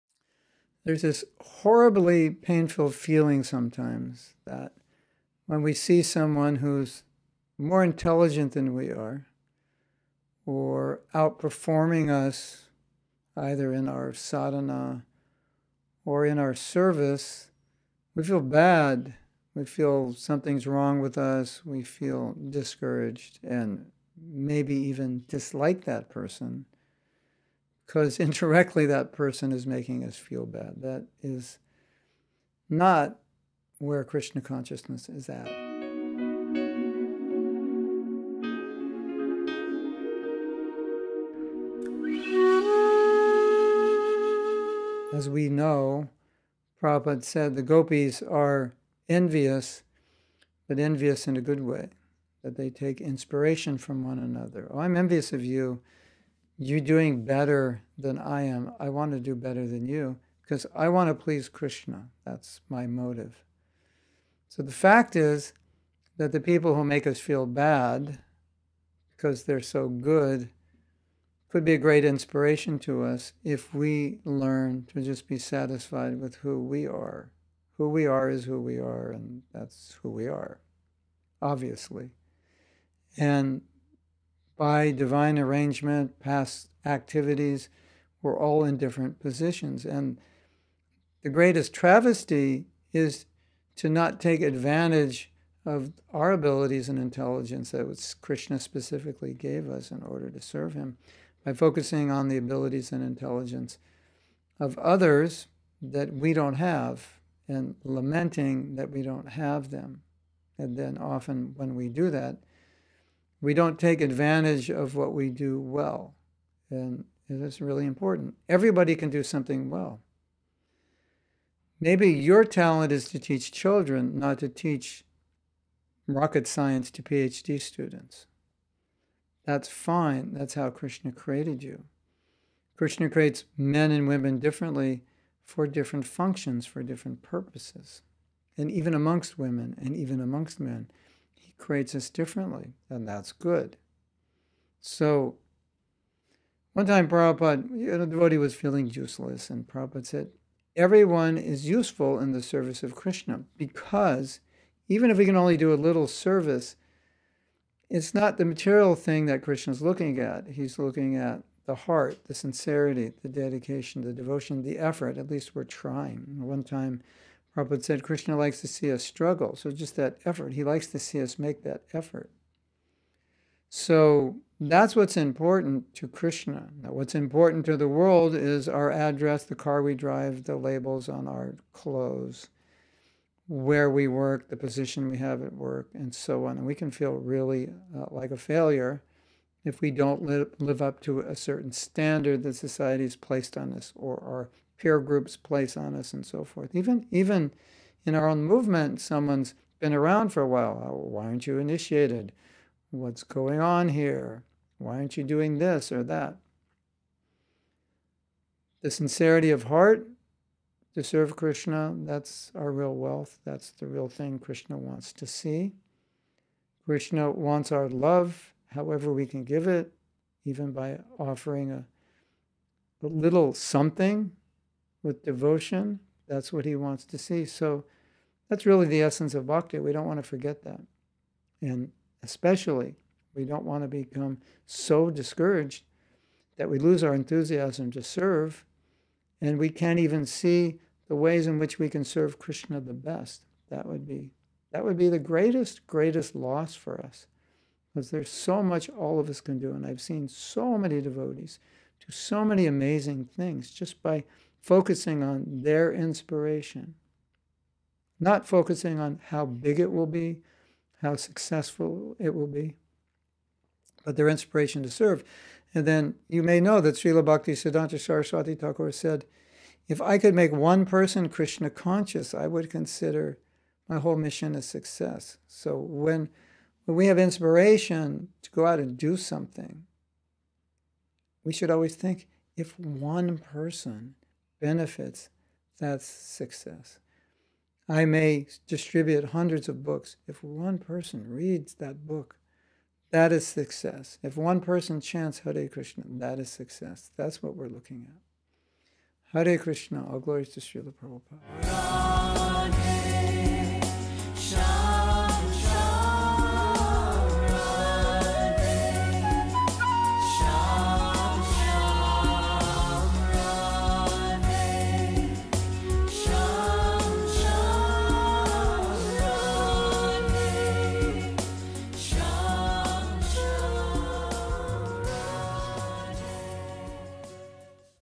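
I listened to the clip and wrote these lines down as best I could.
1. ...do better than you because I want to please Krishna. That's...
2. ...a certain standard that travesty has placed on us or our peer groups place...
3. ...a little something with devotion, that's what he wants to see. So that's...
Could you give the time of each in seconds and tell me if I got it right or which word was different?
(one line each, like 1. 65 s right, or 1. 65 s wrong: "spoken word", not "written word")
1. 59 s right
2. 191 s wrong: "society", not "travesty"
3. 223 s right.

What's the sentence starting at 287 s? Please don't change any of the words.
I may distribute hundreds of books.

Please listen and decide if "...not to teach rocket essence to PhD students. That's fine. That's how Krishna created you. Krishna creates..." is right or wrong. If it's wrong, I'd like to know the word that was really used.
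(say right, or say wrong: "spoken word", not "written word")
wrong: "science", not "essence".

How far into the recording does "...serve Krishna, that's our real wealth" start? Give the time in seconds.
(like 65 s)
211 s.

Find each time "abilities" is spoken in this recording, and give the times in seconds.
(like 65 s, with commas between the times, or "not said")
96 s, 102 s.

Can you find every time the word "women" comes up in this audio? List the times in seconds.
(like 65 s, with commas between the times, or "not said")
134 s, 139 s.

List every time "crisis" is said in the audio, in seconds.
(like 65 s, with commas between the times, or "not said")
not said.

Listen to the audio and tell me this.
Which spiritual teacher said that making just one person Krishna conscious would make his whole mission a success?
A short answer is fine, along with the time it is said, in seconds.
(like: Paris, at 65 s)
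Srila Bhakti Siddhanta Saraswati Thakur, at 266 s.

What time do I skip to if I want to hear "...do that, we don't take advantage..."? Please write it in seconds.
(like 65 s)
111 s.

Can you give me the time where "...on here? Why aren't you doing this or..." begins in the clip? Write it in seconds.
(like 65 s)
203 s.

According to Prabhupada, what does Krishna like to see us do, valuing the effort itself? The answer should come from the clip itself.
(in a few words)
Struggle.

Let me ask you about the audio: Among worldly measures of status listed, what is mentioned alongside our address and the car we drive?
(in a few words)
Labels on our clothes.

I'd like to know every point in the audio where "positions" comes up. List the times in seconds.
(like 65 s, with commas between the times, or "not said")
89 s, 184 s.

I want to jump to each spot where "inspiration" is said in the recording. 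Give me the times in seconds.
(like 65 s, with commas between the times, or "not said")
53 s, 72 s, 255 s, 264 s, 277 s.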